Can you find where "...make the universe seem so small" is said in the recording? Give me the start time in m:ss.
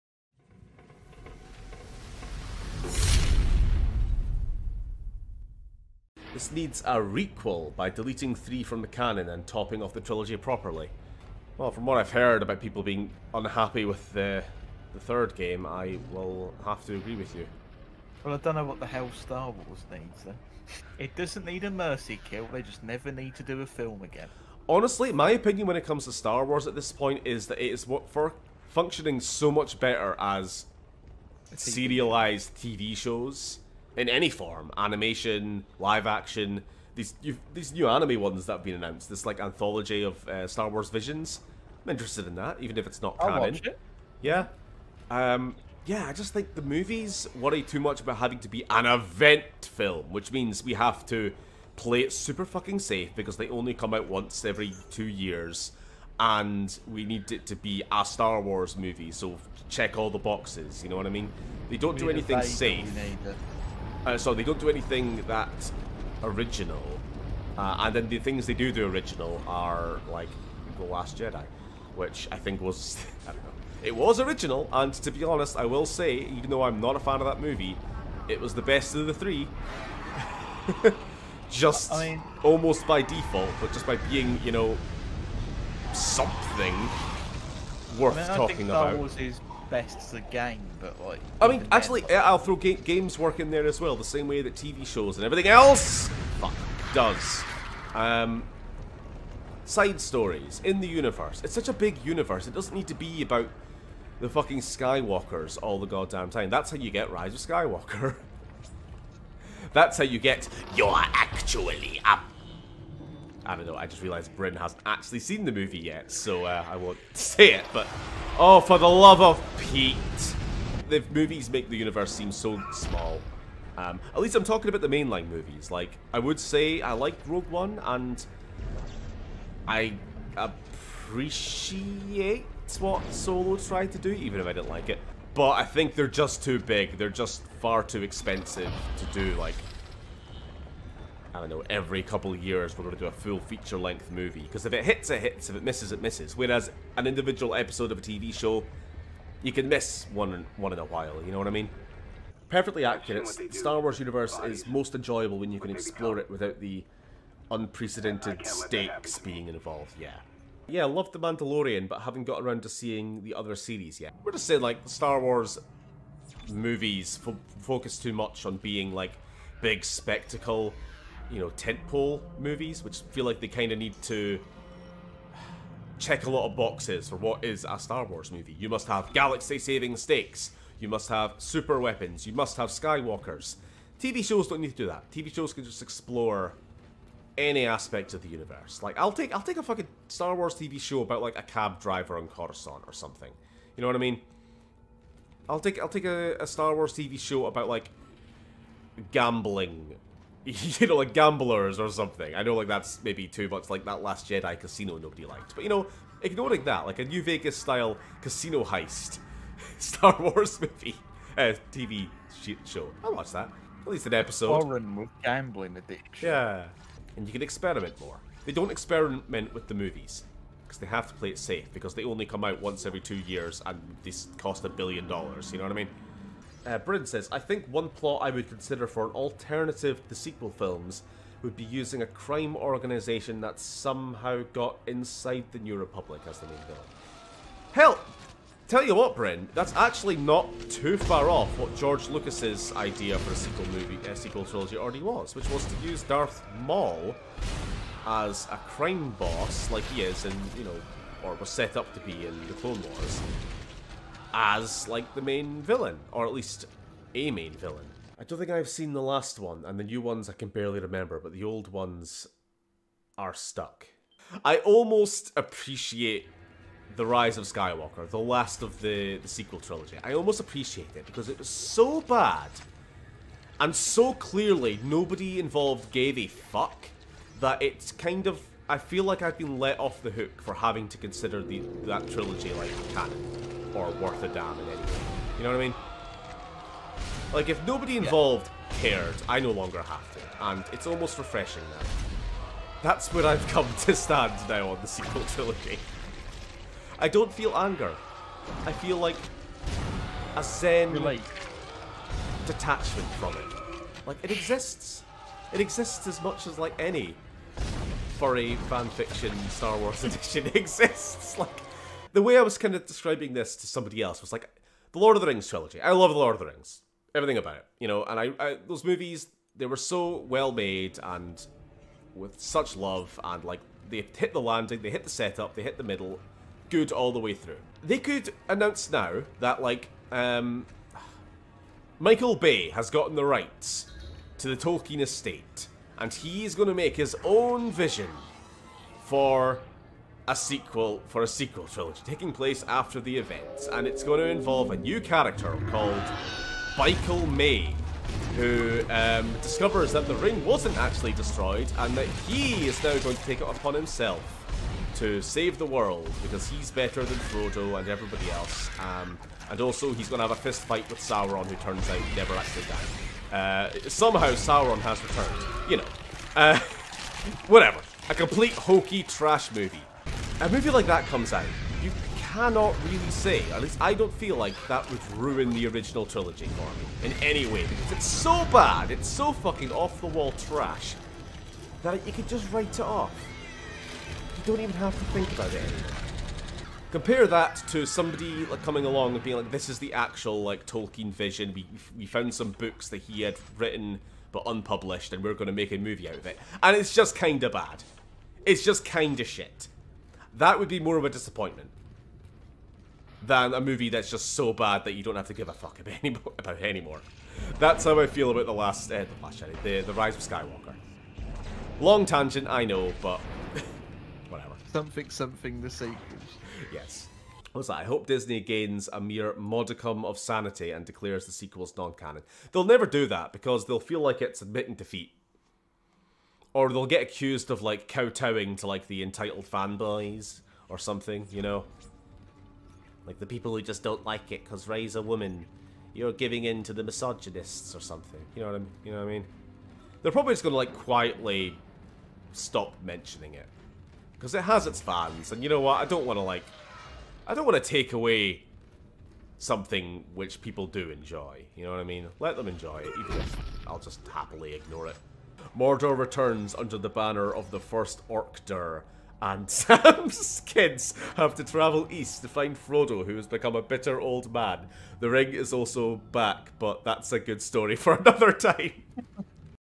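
2:01.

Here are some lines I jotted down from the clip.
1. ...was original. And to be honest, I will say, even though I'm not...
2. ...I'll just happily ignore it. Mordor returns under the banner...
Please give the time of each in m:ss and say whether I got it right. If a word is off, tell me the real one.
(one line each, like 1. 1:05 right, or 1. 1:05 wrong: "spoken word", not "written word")
1. 1:13 right
2. 7:33 right.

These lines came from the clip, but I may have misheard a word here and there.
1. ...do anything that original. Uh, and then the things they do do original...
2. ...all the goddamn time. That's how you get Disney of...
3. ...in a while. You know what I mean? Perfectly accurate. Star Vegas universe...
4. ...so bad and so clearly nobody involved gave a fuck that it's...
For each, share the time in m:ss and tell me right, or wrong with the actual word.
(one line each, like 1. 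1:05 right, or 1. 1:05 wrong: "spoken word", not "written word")
1. 1:04 right
2. 1:45 wrong: "Rise", not "Disney"
3. 2:30 wrong: "Wars", not "Vegas"
4. 4:31 right.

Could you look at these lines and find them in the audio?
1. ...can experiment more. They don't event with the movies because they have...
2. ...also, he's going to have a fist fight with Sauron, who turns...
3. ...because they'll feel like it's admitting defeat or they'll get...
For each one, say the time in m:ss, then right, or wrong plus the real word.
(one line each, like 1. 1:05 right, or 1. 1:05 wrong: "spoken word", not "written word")
1. 3:37 wrong: "experiment", not "event"
2. 5:59 right
3. 7:03 right.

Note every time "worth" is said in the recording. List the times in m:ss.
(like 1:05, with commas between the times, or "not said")
1:27, 4:44.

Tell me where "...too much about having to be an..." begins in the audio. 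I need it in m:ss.
0:47.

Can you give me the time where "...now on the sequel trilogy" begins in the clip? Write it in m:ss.
4:54.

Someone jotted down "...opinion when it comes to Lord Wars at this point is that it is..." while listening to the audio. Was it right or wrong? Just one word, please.
wrong.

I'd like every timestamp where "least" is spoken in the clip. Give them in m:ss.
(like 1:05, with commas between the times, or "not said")
2:04, 3:33, 4:16, 6:13.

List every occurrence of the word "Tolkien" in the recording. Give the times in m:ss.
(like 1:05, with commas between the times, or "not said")
5:34, 6:30.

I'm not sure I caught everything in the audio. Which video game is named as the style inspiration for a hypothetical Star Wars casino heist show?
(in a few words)
New Vegas.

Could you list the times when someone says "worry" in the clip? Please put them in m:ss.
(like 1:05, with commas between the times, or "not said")
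0:47.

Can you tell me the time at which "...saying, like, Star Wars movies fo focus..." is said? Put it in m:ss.
2:44.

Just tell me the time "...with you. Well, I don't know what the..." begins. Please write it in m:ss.
0:17.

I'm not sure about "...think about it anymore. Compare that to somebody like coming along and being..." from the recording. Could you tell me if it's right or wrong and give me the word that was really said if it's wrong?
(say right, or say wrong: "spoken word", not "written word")
right.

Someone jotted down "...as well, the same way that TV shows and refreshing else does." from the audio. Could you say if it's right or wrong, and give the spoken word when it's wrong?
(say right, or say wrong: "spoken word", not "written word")
wrong: "everything", not "refreshing".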